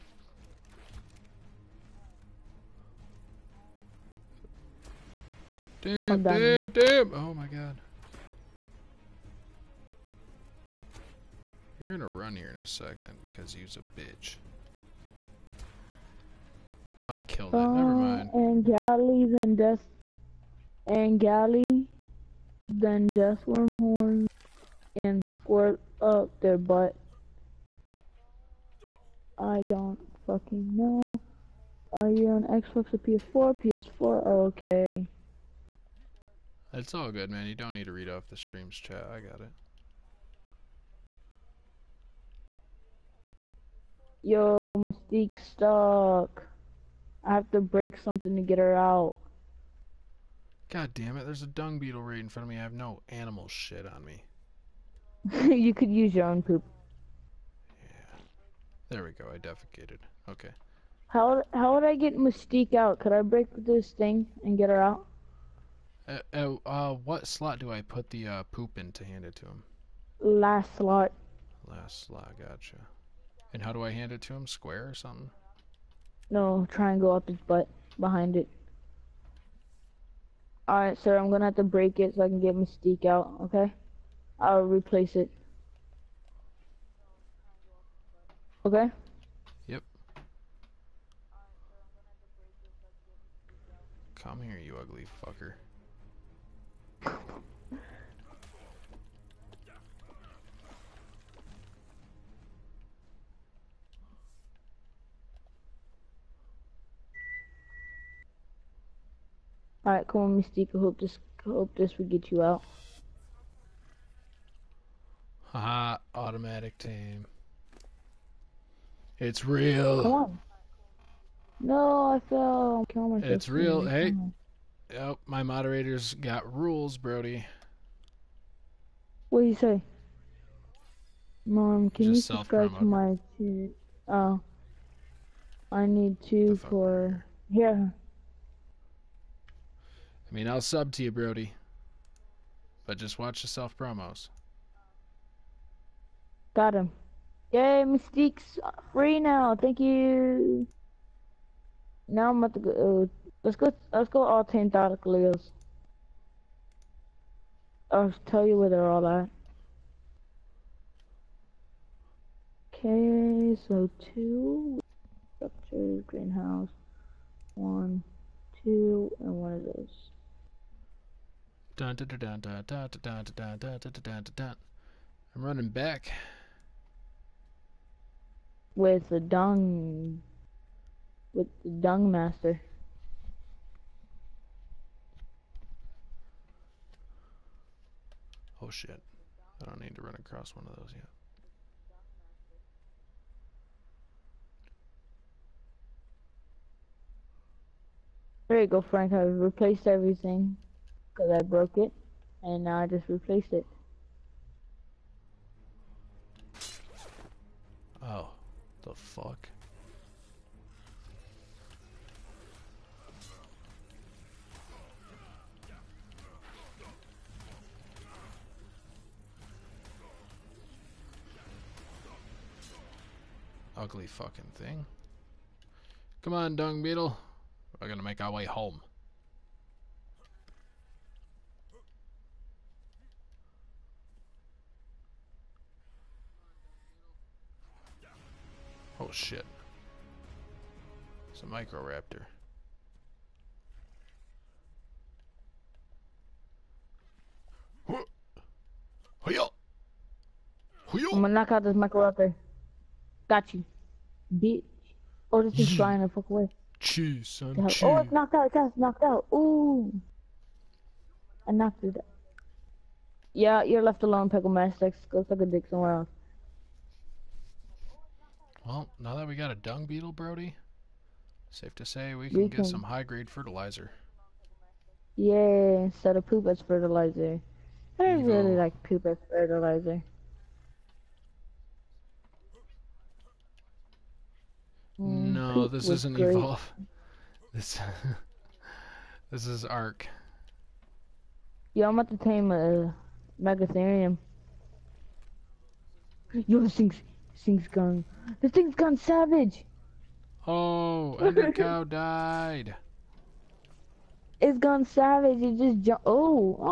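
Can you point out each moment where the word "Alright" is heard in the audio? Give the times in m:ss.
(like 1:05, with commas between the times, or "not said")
1:20, 1:49.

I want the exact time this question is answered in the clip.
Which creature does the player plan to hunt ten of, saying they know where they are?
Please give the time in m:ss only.
2:34.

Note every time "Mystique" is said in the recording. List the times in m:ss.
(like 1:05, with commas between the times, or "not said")
0:44, 1:02, 1:22, 1:50, 2:27.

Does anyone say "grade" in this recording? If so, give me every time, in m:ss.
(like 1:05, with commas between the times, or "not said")
4:32.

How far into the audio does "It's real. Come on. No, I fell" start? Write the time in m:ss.
1:59.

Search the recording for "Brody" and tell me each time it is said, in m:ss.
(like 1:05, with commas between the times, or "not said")
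2:06, 2:21, 4:30.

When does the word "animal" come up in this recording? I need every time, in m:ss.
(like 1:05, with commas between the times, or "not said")
0:53.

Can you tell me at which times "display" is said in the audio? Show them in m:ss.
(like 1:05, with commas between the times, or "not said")
not said.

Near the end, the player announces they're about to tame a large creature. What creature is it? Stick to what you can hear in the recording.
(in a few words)
Megatherium.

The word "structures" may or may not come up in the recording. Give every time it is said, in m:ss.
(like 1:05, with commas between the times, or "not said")
2:45.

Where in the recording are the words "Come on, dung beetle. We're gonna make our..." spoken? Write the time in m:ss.
3:46.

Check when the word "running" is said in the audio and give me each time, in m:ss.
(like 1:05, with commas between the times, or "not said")
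2:55.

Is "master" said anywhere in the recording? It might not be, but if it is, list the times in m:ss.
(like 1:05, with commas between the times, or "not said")
3:02, 4:24.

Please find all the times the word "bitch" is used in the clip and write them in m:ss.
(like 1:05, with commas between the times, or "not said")
0:14, 4:14.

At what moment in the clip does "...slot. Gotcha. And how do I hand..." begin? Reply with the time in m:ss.
1:12.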